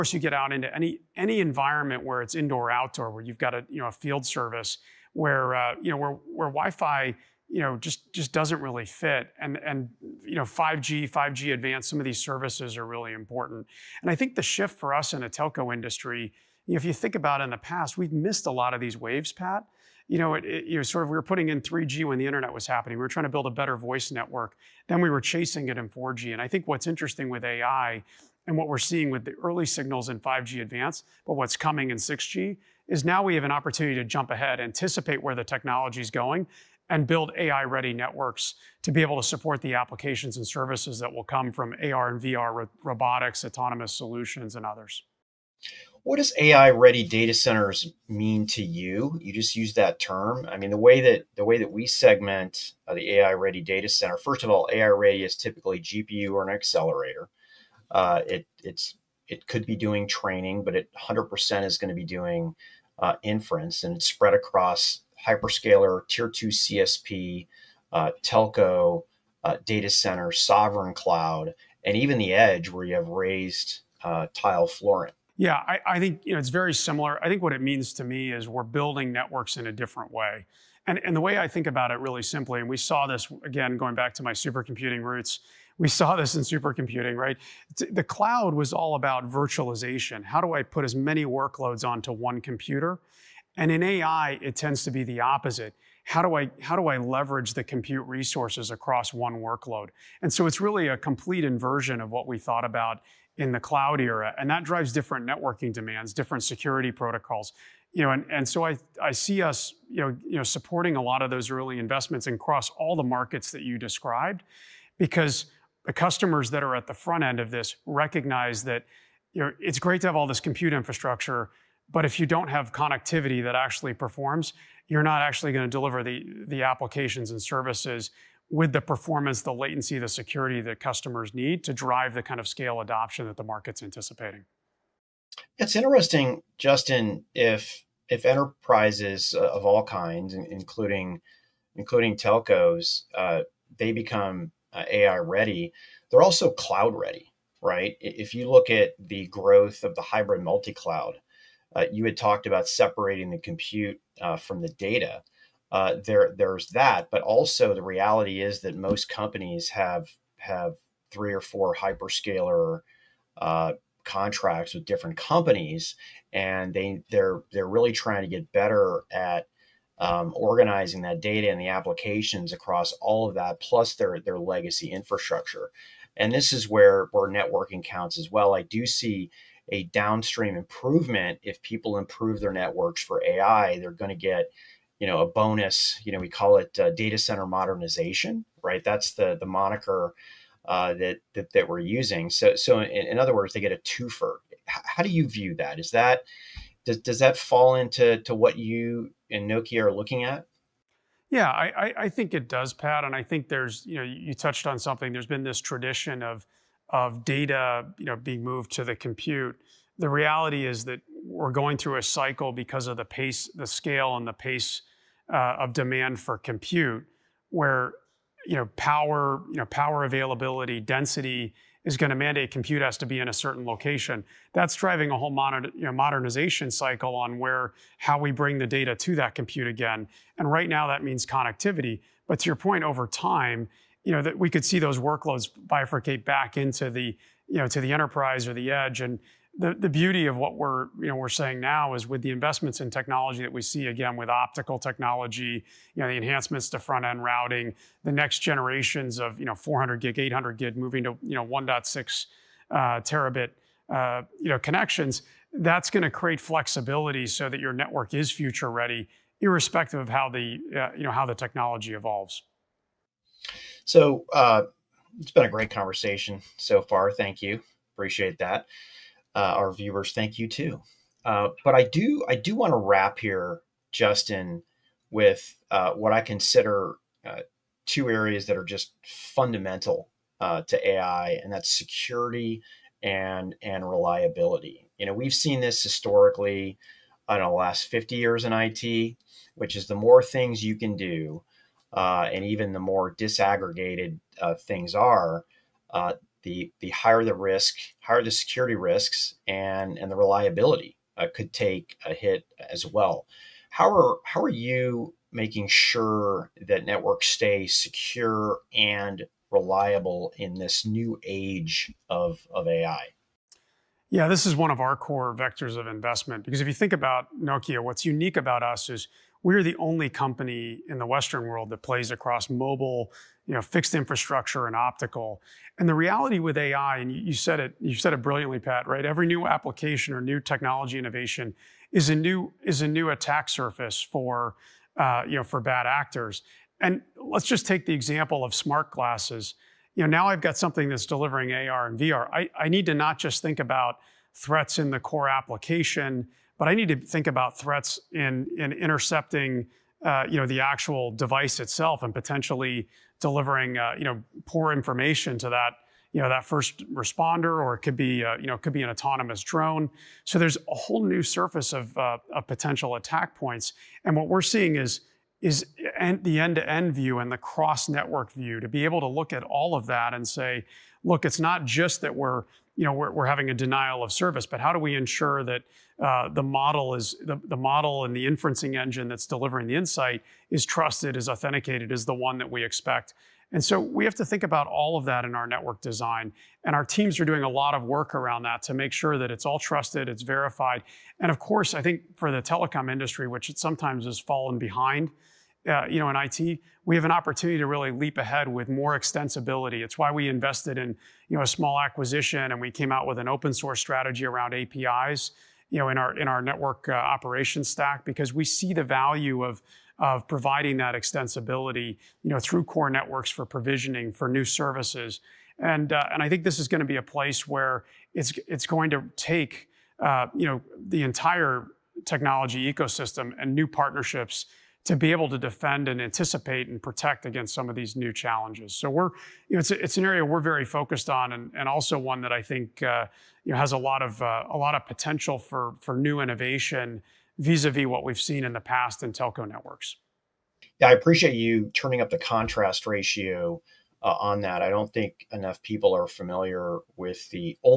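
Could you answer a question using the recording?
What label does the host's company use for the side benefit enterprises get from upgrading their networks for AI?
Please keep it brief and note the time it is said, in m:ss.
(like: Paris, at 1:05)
data center modernization, at 3:06.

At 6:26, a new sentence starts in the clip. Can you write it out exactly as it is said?
And our teams are doing a lot of work around that to make sure that it's all trusted, it's verified.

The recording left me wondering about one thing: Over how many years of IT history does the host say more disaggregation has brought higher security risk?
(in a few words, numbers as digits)
50 years.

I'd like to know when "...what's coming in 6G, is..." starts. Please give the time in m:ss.
0:31.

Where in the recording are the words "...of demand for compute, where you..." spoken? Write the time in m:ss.
3:35.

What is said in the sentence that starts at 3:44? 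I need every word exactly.
That's driving a whole you know, modernization cycle on where how we bring the data to that compute again.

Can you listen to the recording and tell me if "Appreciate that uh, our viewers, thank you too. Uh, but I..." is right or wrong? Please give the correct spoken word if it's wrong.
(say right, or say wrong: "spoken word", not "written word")
right.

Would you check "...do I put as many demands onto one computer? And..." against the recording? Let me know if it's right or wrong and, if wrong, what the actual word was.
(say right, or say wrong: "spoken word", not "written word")
wrong: "workloads", not "demands".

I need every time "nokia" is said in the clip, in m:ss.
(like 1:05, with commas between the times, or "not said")
3:19, 5:17.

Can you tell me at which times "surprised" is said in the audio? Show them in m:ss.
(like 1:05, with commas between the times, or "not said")
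not said.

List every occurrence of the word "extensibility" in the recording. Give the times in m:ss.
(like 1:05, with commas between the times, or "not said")
6:38, 6:50.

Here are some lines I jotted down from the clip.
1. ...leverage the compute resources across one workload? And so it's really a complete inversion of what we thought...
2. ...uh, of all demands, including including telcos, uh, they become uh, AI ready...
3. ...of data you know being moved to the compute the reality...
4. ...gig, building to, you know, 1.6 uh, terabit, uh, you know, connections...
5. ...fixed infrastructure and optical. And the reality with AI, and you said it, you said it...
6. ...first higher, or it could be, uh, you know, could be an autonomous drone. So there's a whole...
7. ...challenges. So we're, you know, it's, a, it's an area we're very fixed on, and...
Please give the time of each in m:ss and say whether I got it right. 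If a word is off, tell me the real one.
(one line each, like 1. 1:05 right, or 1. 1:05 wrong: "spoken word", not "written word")
1. 1:36 right
2. 2:19 wrong: "kinds", not "demands"
3. 3:26 right
4. 4:10 wrong: "moving", not "building"
5. 5:23 right
6. 5:56 wrong: "responder", not "higher"
7. 7:08 wrong: "focused", not "fixed".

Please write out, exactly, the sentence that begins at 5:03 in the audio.
How are how are you making sure that networks stay secure and reliable in this new age of of AI?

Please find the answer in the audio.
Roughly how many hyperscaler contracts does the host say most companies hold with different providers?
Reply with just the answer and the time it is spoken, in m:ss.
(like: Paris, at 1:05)
3 or 4, at 2:41.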